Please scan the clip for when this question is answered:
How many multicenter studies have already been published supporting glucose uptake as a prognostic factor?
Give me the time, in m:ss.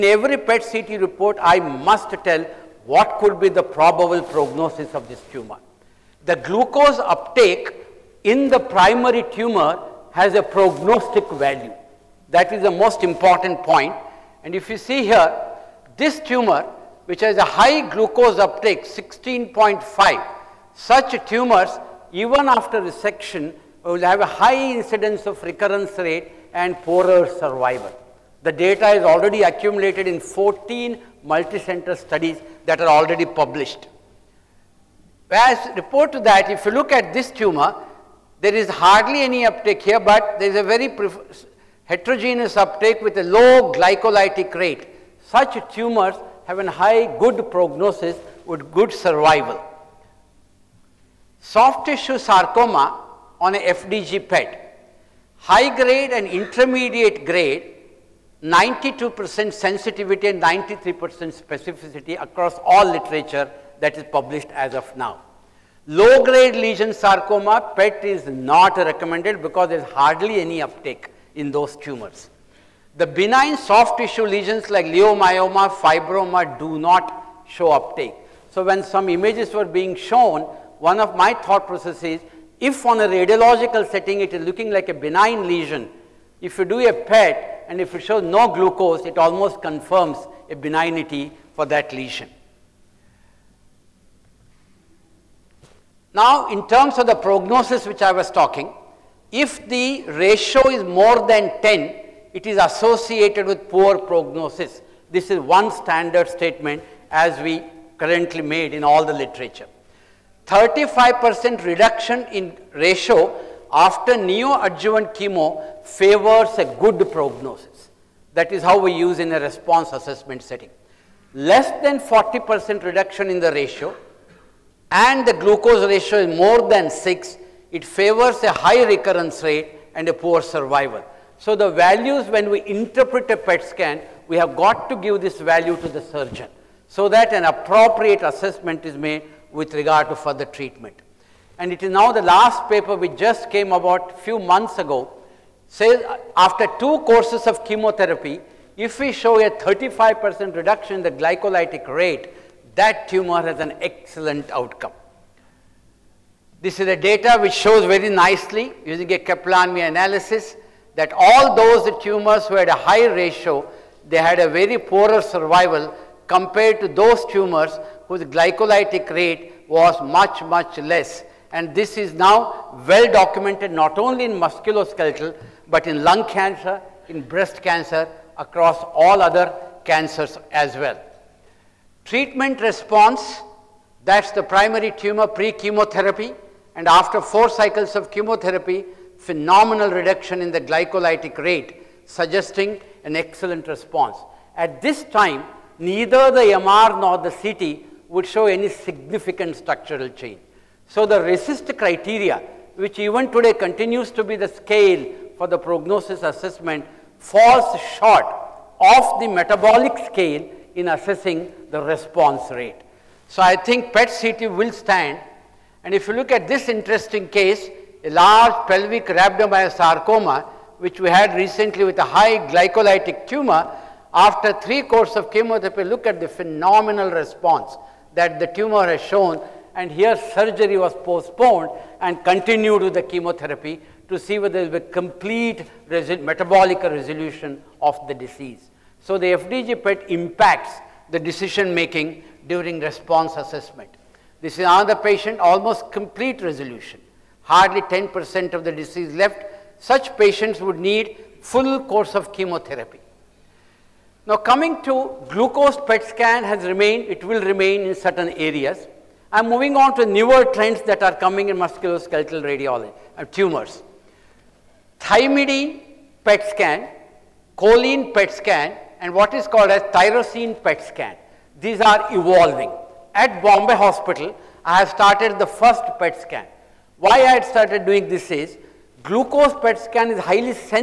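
0:30.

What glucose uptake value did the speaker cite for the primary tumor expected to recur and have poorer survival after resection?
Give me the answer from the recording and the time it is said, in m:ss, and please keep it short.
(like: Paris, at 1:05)
16.5, at 0:18.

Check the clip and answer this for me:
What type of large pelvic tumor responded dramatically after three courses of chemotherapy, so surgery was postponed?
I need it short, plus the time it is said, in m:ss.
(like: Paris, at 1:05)
Rhabdomyosarcoma, at 3:39.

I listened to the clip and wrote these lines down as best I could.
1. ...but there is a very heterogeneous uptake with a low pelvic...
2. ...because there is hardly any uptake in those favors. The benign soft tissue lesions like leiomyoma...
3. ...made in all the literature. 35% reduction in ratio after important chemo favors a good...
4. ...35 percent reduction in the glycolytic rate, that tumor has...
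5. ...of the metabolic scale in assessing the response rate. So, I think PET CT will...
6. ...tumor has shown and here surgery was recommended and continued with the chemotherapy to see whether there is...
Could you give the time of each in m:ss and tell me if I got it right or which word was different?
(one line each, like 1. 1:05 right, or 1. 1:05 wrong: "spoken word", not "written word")
1. 0:39 wrong: "glycolytic", not "pelvic"
2. 1:09 wrong: "tumors", not "favors"
3. 1:48 wrong: "neoadjuvant", not "important"
4. 2:29 right
5. 3:28 right
6. 3:48 wrong: "postponed", not "recommended".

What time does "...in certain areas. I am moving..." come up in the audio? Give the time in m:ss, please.
4:17.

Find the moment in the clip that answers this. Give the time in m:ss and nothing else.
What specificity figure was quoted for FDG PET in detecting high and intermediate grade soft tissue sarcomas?
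1:00.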